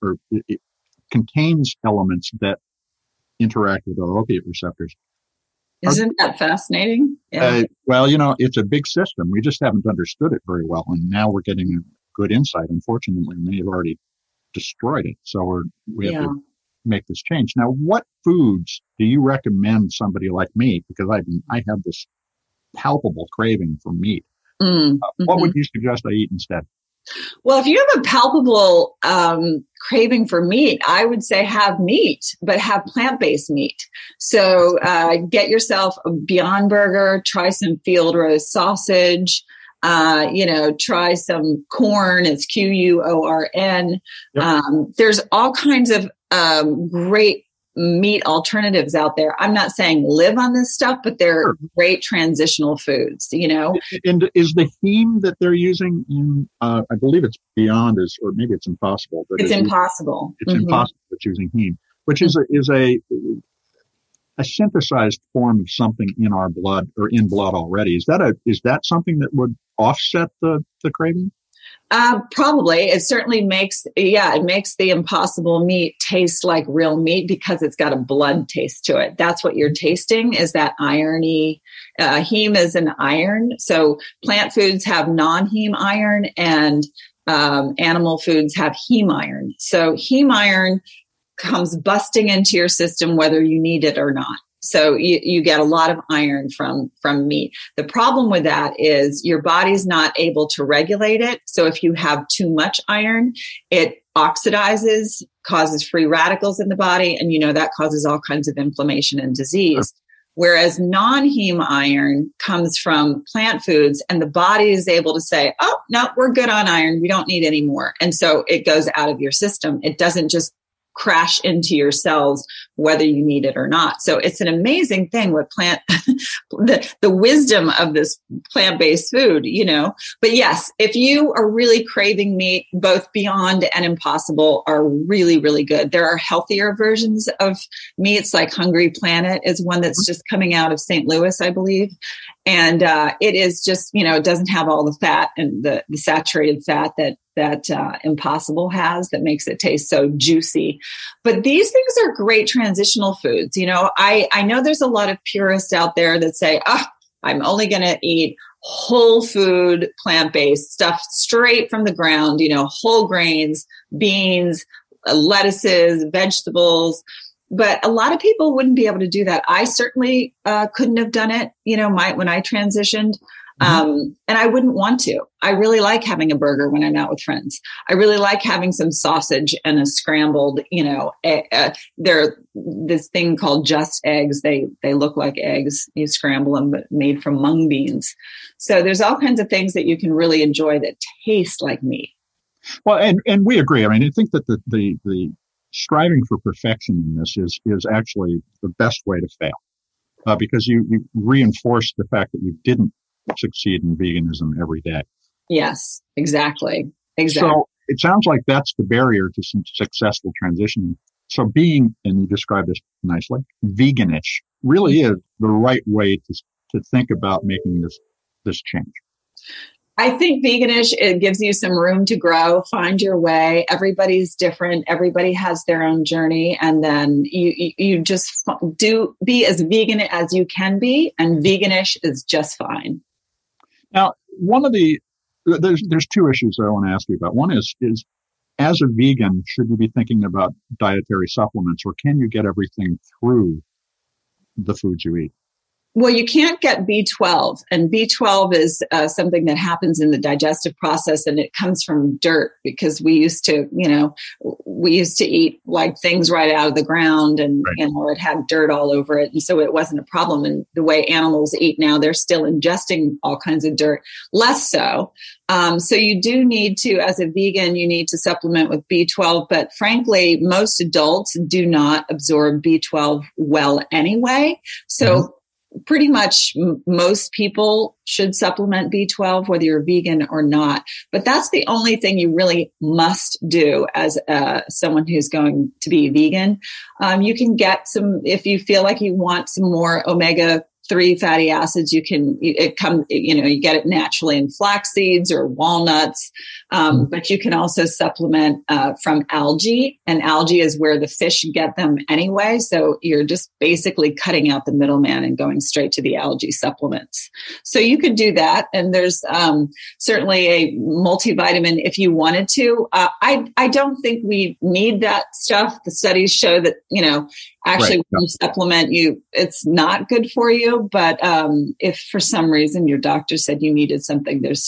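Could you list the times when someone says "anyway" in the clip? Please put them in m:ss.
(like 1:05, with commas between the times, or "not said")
4:33, 5:02.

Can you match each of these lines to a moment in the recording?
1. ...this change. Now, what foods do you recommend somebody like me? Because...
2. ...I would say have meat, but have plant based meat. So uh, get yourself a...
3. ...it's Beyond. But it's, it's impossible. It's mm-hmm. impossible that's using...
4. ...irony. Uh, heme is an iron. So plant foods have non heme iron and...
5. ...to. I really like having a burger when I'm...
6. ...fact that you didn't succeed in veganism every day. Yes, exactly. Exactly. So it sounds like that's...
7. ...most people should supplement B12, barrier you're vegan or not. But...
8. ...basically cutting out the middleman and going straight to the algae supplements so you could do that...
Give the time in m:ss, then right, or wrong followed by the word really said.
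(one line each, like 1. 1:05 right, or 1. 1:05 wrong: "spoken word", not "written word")
1. 0:17 right
2. 0:30 right
3. 0:58 wrong: "Impossible", not "Beyond"
4. 1:20 right
5. 2:55 right
6. 3:22 right
7. 4:36 wrong: "whether", not "barrier"
8. 5:03 right.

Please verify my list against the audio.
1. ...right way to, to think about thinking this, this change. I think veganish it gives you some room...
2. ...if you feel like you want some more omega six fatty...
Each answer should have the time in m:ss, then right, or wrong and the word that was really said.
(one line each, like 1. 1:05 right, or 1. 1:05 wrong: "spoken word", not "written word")
1. 3:35 wrong: "making", not "thinking"
2. 4:48 wrong: "three", not "six".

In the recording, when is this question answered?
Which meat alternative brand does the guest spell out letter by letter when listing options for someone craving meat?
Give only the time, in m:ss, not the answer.
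0:41.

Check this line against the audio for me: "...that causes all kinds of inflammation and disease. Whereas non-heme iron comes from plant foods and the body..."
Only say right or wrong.
right.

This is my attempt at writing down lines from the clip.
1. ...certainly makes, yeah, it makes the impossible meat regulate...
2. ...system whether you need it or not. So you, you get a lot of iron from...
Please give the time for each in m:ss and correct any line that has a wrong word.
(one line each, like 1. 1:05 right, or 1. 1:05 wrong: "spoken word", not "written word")
1. 1:13 wrong: "taste", not "regulate"
2. 1:32 right.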